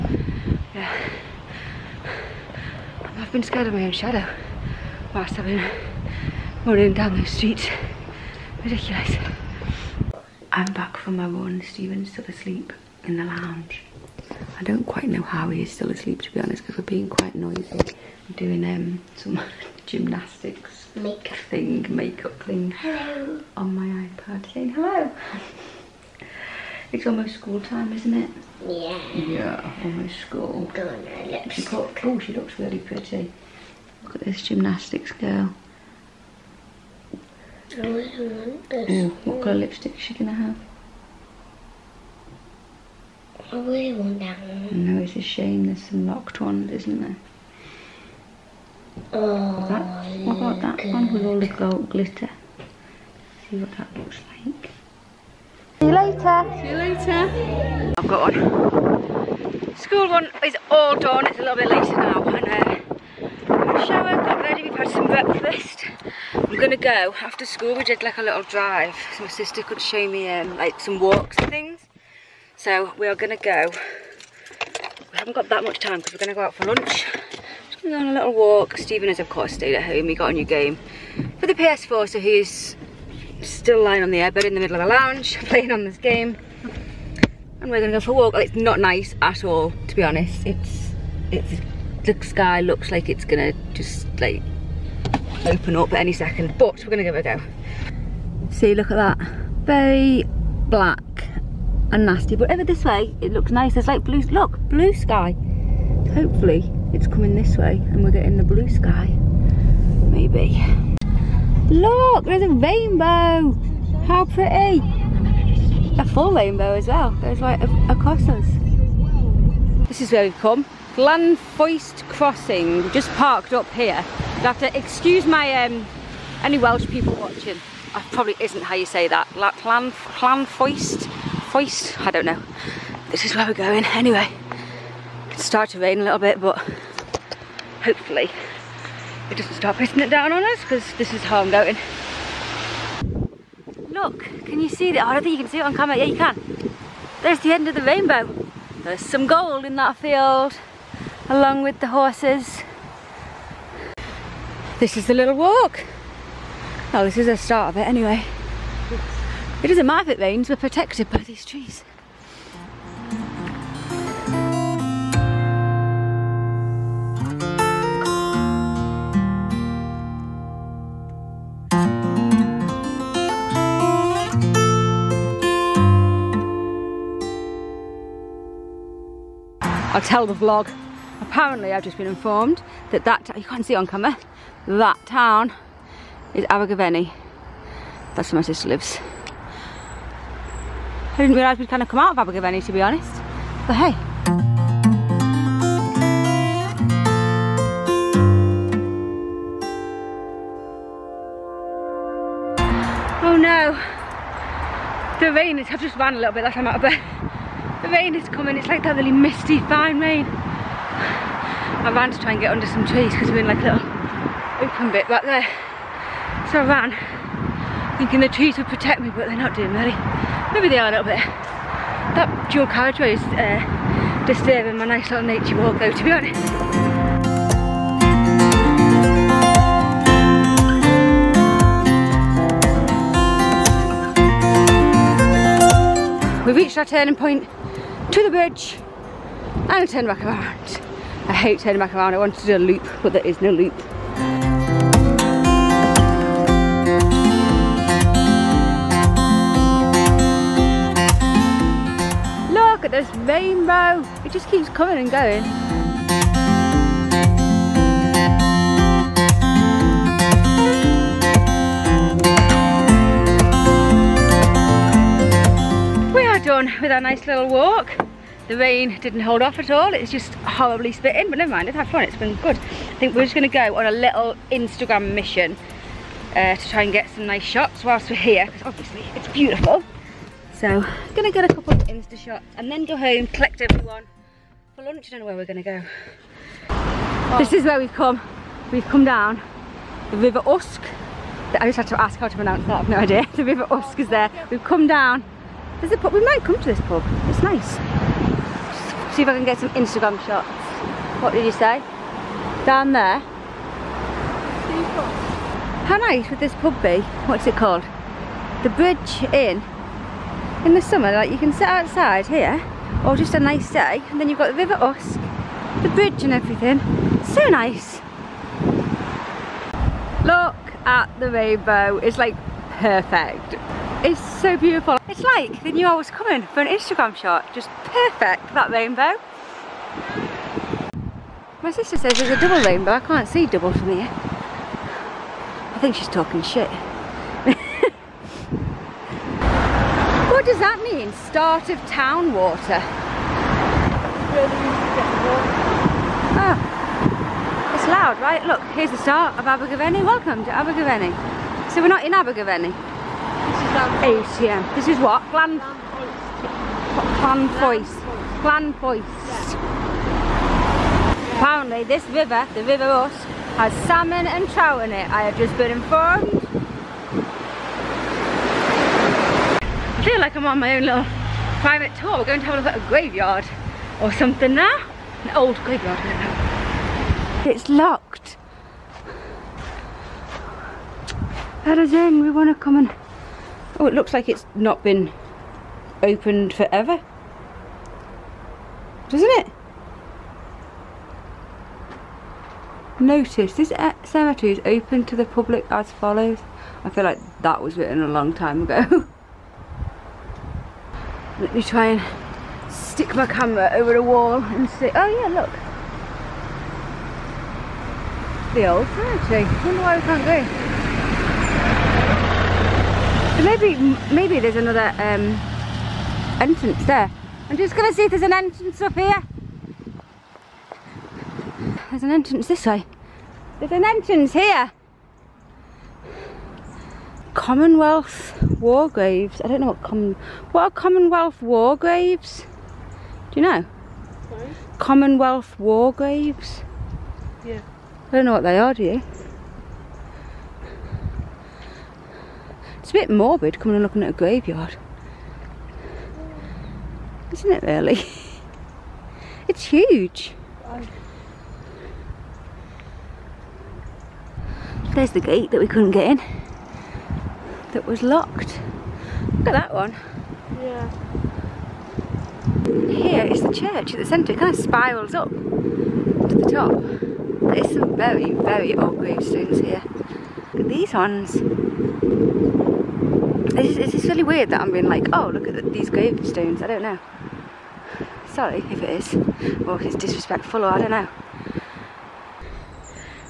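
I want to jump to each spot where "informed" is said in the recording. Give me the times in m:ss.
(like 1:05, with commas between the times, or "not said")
3:02, 6:05.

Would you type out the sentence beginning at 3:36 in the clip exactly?
So I ran, thinking the trees would protect me, but they're not doing really.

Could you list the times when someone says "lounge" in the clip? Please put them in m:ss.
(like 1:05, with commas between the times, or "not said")
0:13, 1:24.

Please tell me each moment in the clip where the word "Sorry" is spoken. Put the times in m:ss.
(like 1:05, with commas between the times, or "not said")
7:14, 7:58.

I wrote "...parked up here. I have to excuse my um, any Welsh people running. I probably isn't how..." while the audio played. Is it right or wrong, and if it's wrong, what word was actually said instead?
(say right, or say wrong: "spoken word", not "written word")
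wrong: "watching", not "running".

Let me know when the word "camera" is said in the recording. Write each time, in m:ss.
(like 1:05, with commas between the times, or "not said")
2:25, 3:03, 6:43.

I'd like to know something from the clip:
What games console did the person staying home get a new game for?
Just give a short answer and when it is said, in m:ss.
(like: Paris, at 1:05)
PS4, at 1:21.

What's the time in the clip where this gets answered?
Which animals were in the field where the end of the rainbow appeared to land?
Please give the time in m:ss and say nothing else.
2:31.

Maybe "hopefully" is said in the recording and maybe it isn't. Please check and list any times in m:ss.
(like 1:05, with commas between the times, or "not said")
1:46, 2:17.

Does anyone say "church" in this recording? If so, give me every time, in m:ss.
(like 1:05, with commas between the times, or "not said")
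7:43.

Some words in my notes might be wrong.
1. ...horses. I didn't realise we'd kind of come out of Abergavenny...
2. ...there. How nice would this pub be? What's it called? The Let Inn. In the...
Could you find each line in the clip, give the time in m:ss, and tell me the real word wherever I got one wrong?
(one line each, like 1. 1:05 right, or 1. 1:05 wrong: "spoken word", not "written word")
1. 3:08 wrong: "lives", not "horses"
2. 5:02 wrong: "Bridge", not "Let".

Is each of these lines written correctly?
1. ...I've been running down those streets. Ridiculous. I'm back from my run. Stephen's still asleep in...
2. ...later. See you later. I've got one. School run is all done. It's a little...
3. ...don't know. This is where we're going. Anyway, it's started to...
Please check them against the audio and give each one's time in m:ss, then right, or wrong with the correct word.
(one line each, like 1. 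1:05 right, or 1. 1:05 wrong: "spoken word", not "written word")
1. 0:05 right
2. 0:55 right
3. 2:12 right.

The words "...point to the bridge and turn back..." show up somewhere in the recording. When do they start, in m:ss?
3:57.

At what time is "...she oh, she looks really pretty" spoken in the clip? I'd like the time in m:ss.
0:31.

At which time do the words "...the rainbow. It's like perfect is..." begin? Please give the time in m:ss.
5:21.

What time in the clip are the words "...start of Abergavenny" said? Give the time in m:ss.
5:48.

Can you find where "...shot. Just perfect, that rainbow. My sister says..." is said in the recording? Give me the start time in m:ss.
5:27.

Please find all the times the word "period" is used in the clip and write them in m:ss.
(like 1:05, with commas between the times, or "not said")
not said.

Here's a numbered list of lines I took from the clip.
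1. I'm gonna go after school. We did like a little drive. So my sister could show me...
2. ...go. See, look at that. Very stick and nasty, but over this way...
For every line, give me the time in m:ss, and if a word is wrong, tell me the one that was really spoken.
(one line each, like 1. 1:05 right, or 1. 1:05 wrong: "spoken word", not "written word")
1. 1:06 right
2. 1:37 wrong: "black", not "stick".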